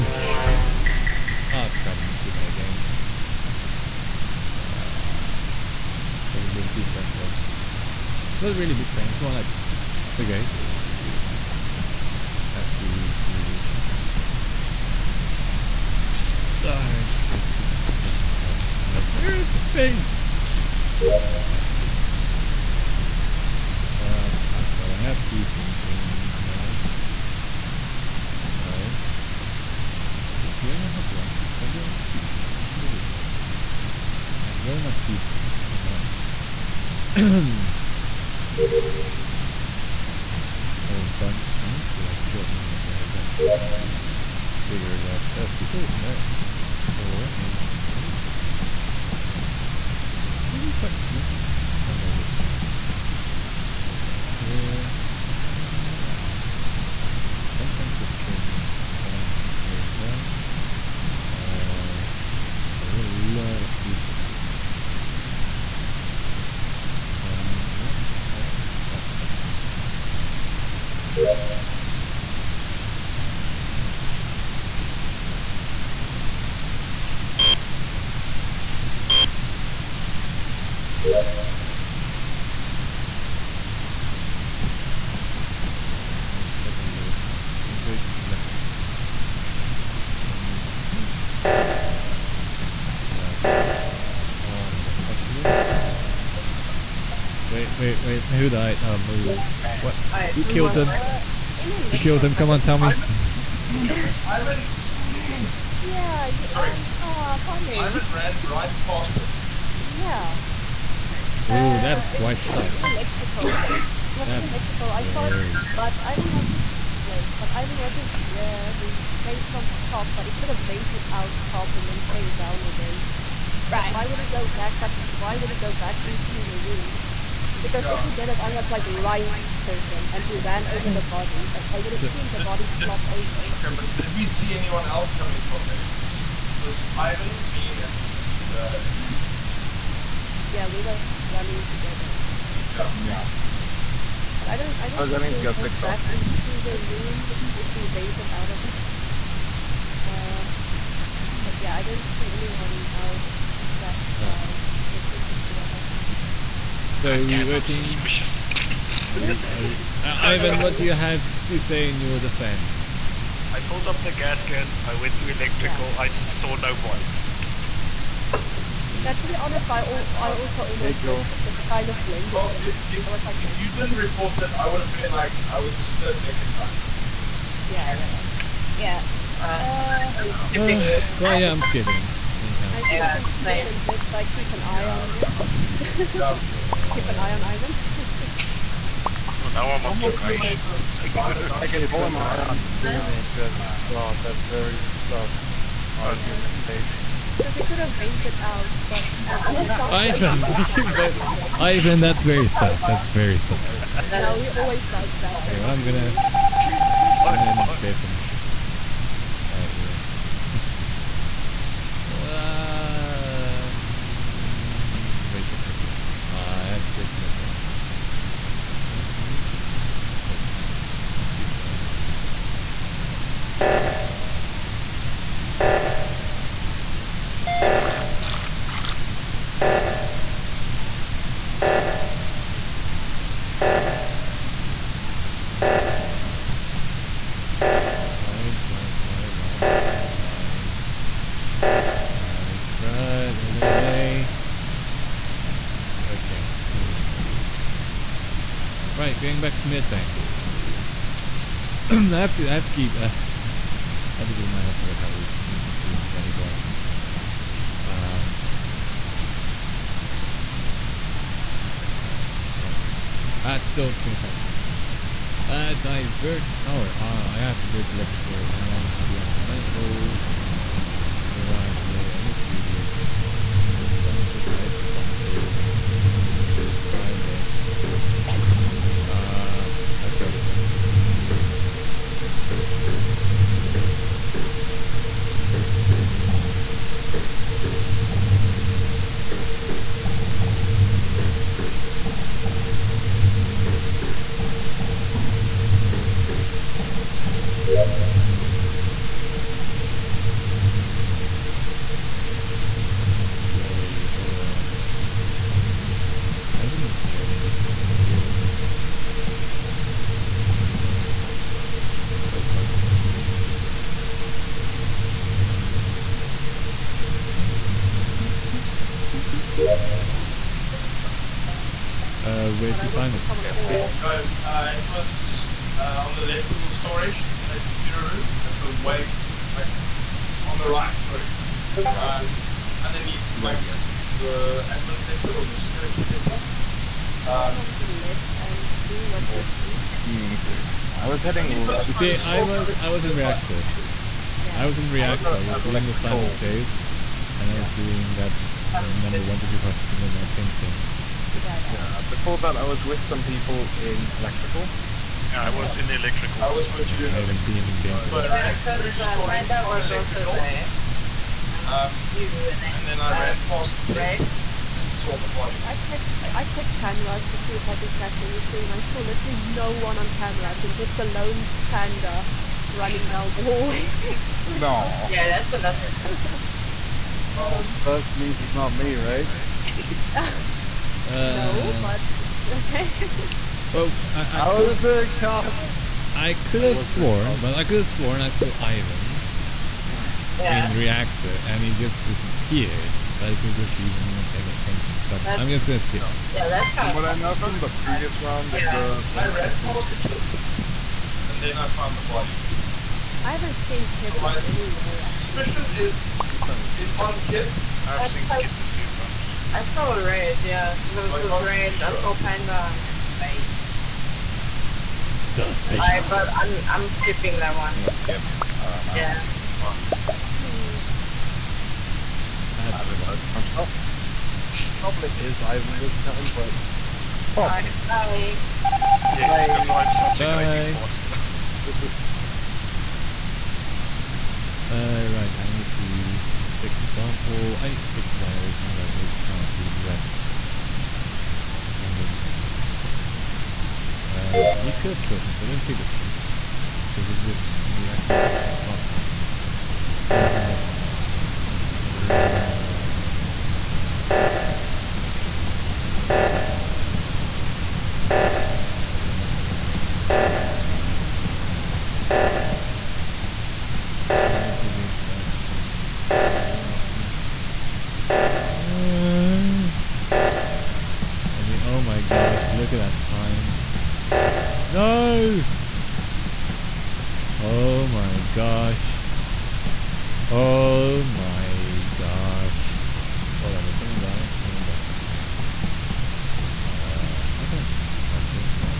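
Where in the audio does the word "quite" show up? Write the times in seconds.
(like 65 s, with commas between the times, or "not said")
50 s, 112 s.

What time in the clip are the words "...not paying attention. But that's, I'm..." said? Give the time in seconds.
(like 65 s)
393 s.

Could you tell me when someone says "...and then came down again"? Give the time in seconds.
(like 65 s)
121 s.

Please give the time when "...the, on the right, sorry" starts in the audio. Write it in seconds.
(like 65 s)
329 s.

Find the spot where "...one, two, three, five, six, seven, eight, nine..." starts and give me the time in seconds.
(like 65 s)
349 s.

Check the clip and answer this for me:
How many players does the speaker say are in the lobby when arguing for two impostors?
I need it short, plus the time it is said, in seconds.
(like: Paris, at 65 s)
9, at 35 s.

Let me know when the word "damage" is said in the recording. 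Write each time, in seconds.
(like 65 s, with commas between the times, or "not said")
not said.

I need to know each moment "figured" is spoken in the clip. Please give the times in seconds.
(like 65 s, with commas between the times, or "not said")
44 s.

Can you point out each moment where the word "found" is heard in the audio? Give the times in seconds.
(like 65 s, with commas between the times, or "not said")
401 s.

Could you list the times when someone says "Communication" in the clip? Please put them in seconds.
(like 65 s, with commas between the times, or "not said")
339 s.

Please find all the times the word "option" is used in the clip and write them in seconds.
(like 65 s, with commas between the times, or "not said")
not said.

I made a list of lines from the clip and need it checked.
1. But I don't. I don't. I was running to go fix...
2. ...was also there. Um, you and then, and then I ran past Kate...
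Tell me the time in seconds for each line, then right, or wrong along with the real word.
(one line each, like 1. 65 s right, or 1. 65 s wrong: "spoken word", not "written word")
1. 144 s right
2. 359 s right.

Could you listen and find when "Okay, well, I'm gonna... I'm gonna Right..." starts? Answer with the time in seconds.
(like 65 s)
205 s.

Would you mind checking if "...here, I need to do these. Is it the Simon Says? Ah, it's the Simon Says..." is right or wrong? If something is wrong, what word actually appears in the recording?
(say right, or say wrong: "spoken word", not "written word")
right.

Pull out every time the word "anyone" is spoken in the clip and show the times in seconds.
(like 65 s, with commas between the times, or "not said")
134 s, 152 s.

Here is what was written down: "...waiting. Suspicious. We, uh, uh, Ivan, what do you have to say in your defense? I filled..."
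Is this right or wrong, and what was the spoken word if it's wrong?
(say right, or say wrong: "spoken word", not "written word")
right.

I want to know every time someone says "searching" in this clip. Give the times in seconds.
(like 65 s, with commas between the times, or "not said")
129 s.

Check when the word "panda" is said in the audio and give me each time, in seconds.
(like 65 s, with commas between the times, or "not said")
371 s, 412 s.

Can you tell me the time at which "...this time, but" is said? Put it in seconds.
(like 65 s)
425 s.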